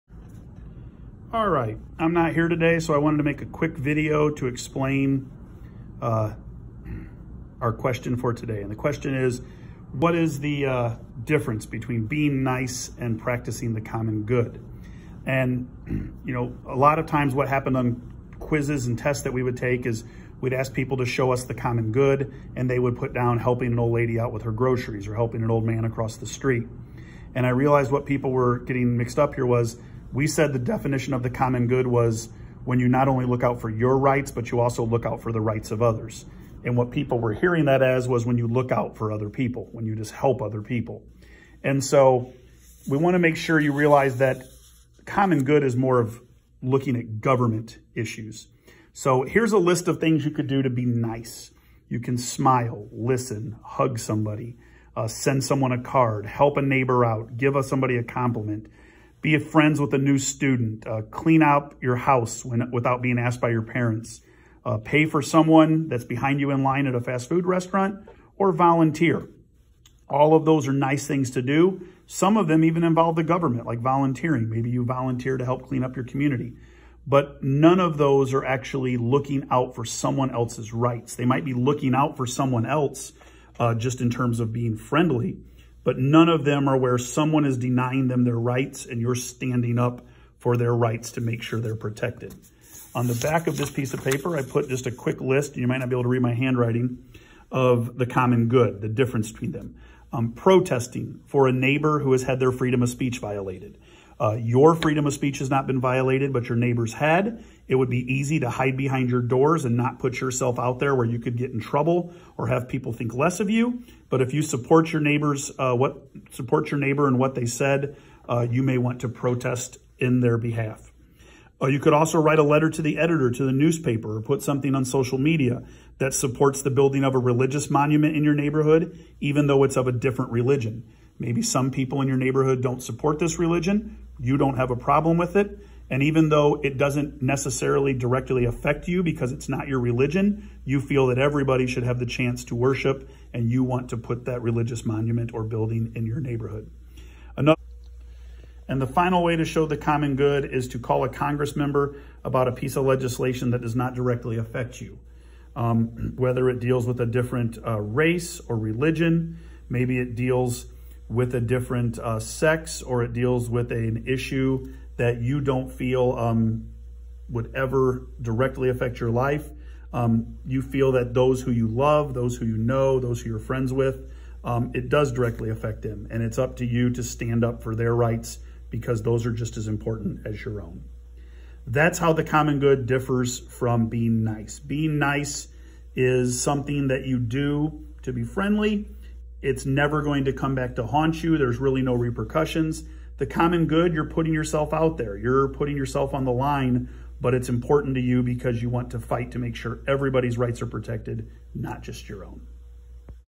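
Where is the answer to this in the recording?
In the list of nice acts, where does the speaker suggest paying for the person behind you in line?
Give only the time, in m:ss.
1:07.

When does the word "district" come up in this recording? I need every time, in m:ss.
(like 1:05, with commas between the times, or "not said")
not said.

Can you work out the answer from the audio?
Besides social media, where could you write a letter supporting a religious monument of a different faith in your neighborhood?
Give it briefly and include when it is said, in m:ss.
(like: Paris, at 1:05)
the newspaper, at 2:03.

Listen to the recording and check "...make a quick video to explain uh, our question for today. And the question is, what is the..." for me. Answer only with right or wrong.
right.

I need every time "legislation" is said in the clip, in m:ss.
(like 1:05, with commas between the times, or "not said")
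2:32.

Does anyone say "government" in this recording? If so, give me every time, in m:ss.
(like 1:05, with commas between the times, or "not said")
0:47, 1:13.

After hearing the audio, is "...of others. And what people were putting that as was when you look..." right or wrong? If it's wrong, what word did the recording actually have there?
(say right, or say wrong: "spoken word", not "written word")
wrong: "hearing", not "putting".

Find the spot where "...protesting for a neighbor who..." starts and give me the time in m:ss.
1:40.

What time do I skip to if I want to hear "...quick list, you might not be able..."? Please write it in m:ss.
1:34.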